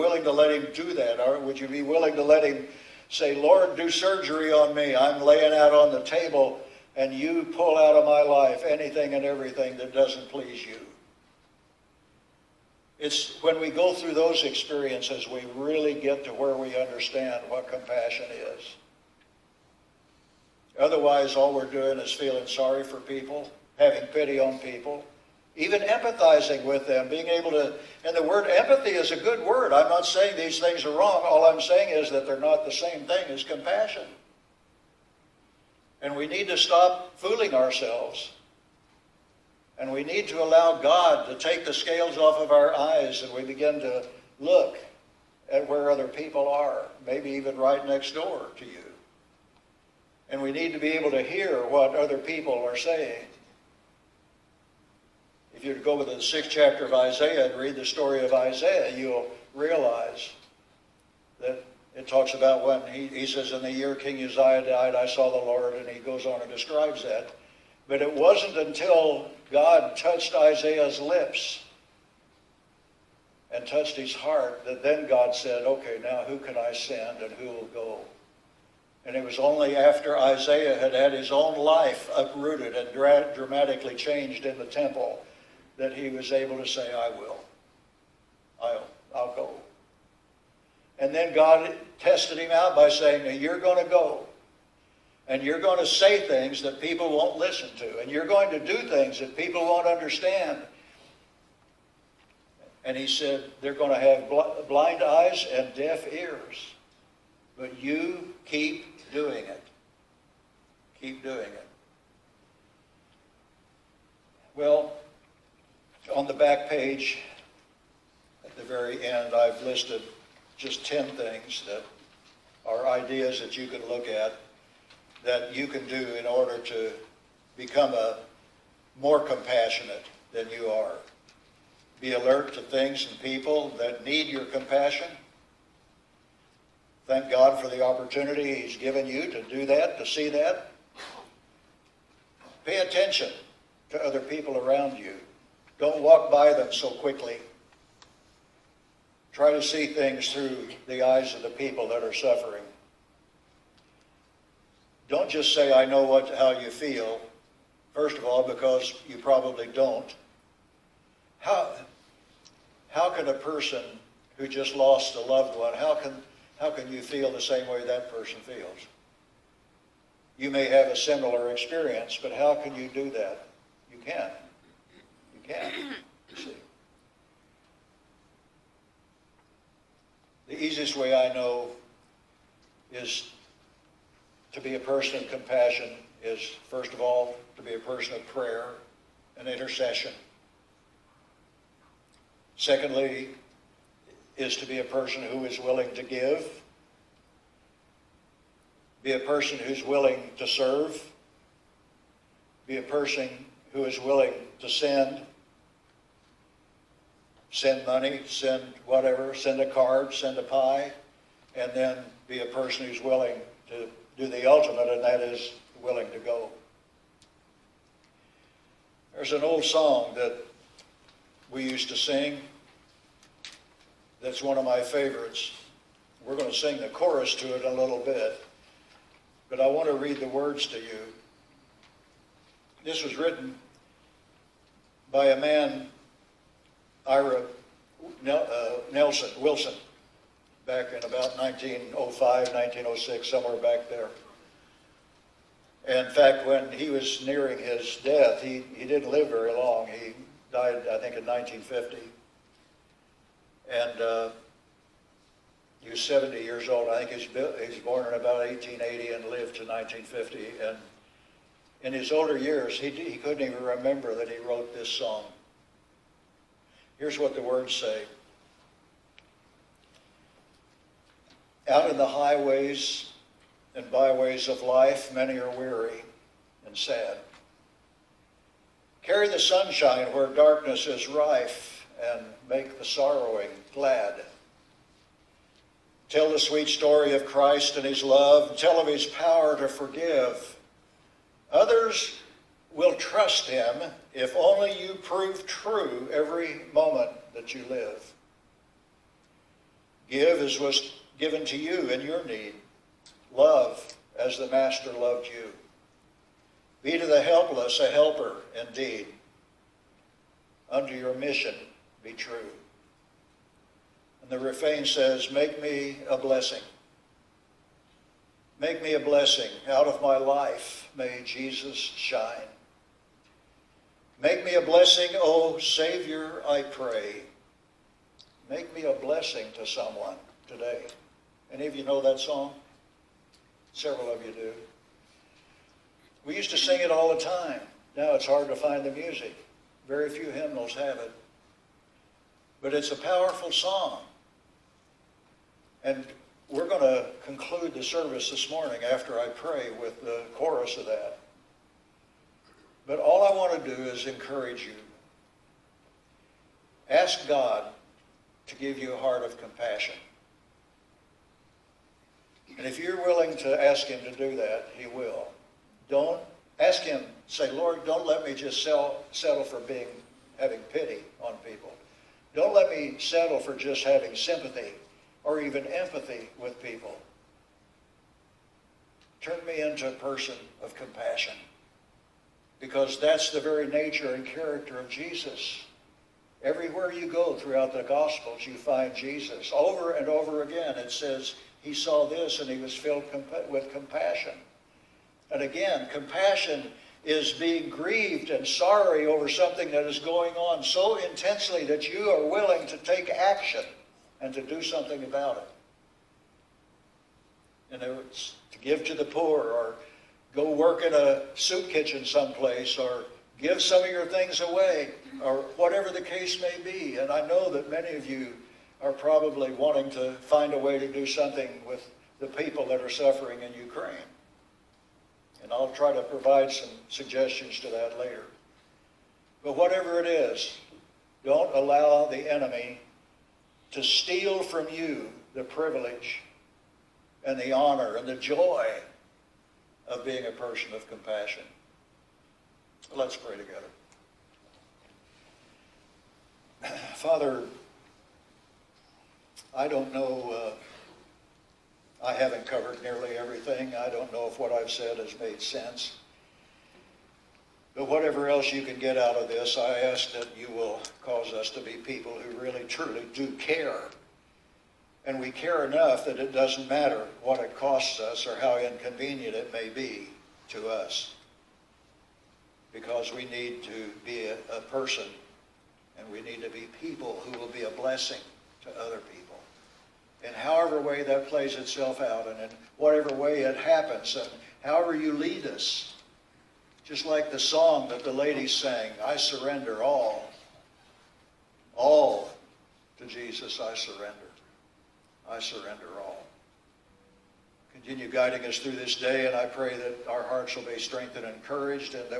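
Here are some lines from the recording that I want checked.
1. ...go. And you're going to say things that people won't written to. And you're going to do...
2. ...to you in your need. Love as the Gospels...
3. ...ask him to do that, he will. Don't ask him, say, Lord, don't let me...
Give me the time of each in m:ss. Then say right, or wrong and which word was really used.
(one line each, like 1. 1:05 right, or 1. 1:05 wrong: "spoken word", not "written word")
1. 1:33 wrong: "listen", not "written"
2. 5:01 wrong: "Master", not "Gospels"
3. 6:03 right.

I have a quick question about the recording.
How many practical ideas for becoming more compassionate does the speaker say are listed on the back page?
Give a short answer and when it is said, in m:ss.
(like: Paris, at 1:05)
10, at 2:00.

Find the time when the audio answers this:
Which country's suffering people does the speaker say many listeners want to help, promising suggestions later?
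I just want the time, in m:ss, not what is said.
7:03.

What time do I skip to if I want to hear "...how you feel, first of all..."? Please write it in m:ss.
2:36.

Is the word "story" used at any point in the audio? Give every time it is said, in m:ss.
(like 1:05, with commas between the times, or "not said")
0:57, 4:46.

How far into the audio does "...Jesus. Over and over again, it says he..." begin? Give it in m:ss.
6:28.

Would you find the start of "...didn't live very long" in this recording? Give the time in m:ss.
4:08.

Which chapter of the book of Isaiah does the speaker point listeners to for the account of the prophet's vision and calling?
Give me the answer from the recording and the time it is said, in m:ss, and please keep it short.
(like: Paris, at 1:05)
sixth chapter, at 0:56.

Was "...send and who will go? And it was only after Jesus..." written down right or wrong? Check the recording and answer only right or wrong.
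wrong.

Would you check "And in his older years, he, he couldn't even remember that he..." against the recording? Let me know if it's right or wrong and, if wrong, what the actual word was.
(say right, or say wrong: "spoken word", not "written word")
right.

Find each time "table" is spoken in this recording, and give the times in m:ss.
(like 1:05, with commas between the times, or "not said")
0:06.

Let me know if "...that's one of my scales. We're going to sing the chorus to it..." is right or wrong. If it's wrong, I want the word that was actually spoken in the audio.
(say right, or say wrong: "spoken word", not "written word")
wrong: "favorites", not "scales".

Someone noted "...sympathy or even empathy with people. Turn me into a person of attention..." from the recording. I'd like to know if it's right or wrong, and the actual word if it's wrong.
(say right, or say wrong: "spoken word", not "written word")
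wrong: "compassion", not "attention".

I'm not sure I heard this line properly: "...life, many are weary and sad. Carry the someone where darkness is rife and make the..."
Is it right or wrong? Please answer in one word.
wrong.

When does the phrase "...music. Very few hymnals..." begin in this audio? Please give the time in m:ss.
5:38.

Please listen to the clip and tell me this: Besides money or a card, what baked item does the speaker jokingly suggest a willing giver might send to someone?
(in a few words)
a pie.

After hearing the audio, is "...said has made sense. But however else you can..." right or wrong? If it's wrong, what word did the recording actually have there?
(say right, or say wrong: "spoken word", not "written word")
wrong: "whatever", not "however".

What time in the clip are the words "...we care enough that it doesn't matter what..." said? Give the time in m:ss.
7:45.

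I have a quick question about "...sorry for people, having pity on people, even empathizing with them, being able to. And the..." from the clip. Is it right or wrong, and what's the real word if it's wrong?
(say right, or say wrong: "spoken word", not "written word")
right.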